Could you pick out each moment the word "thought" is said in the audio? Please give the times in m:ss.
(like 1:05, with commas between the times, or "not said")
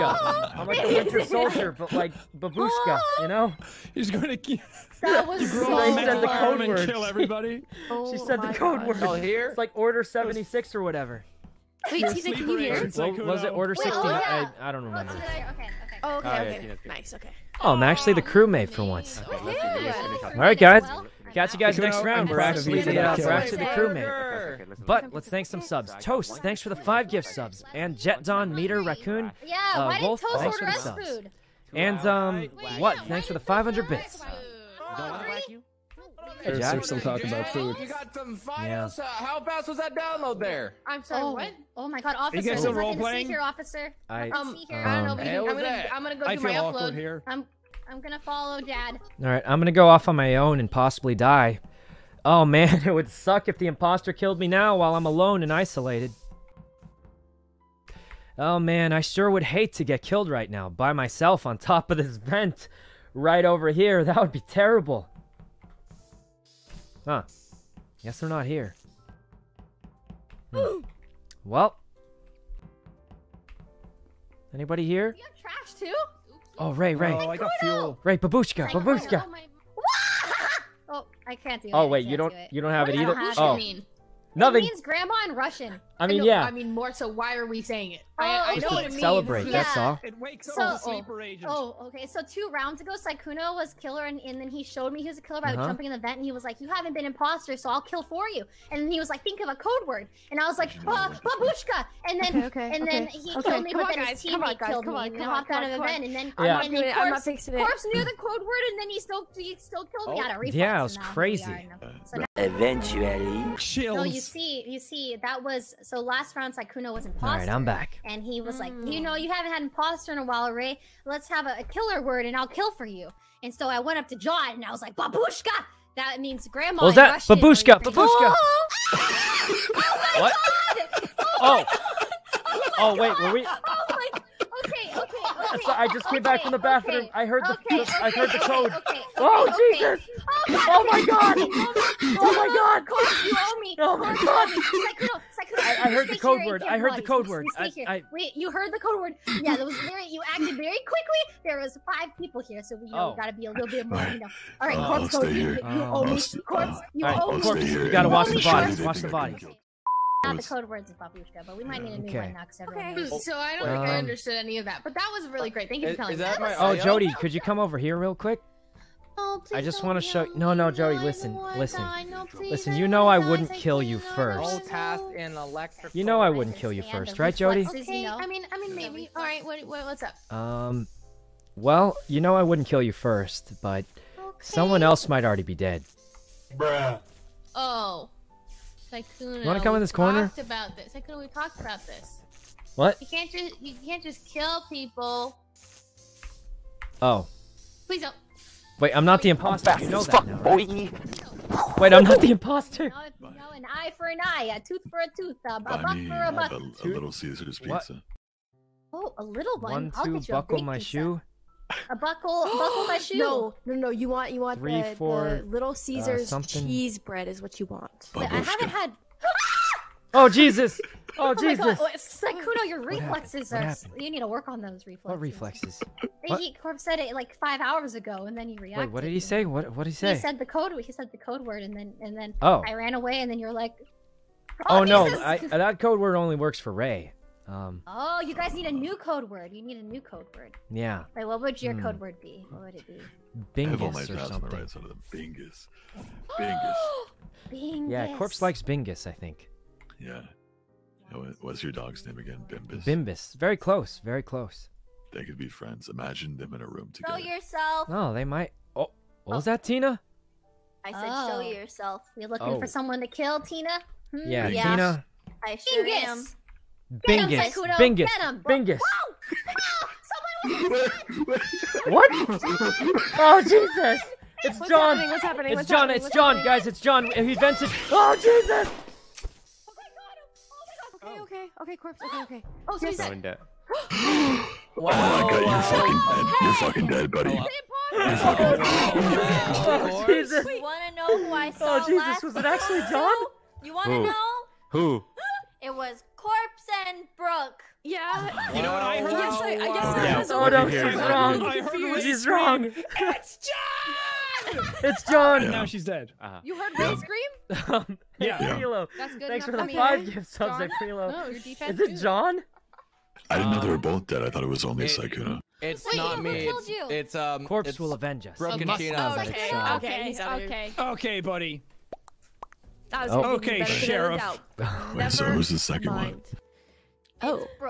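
5:14.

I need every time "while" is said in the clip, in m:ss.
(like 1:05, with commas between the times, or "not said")
0:54, 2:00.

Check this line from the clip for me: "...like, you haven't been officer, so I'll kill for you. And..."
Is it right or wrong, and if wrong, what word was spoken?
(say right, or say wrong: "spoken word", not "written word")
wrong: "imposter", not "officer".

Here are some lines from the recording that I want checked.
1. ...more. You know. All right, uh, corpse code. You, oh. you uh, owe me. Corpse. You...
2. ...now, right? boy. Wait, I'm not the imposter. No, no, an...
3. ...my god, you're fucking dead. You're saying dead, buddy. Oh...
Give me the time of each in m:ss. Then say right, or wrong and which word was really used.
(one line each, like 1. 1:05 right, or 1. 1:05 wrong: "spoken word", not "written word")
1. 2:33 right
2. 3:20 right
3. 4:44 wrong: "fucking", not "saying".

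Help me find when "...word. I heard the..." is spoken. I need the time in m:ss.
2:26.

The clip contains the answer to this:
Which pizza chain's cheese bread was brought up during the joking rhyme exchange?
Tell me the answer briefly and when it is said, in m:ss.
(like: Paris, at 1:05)
Little Caesar's, at 3:35.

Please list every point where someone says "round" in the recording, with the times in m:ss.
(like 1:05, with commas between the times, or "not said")
0:22, 1:32, 1:56.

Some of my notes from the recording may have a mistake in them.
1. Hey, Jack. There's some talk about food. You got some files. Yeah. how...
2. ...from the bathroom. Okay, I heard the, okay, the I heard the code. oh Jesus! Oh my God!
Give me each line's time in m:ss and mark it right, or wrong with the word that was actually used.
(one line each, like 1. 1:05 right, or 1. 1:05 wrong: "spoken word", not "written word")
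1. 0:36 right
2. 2:16 right.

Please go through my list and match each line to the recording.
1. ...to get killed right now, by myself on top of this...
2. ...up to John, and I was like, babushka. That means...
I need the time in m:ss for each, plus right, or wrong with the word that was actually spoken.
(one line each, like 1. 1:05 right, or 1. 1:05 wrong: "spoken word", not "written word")
1. 0:59 right
2. 2:03 right.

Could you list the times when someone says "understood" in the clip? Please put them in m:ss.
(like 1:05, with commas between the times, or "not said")
2:43.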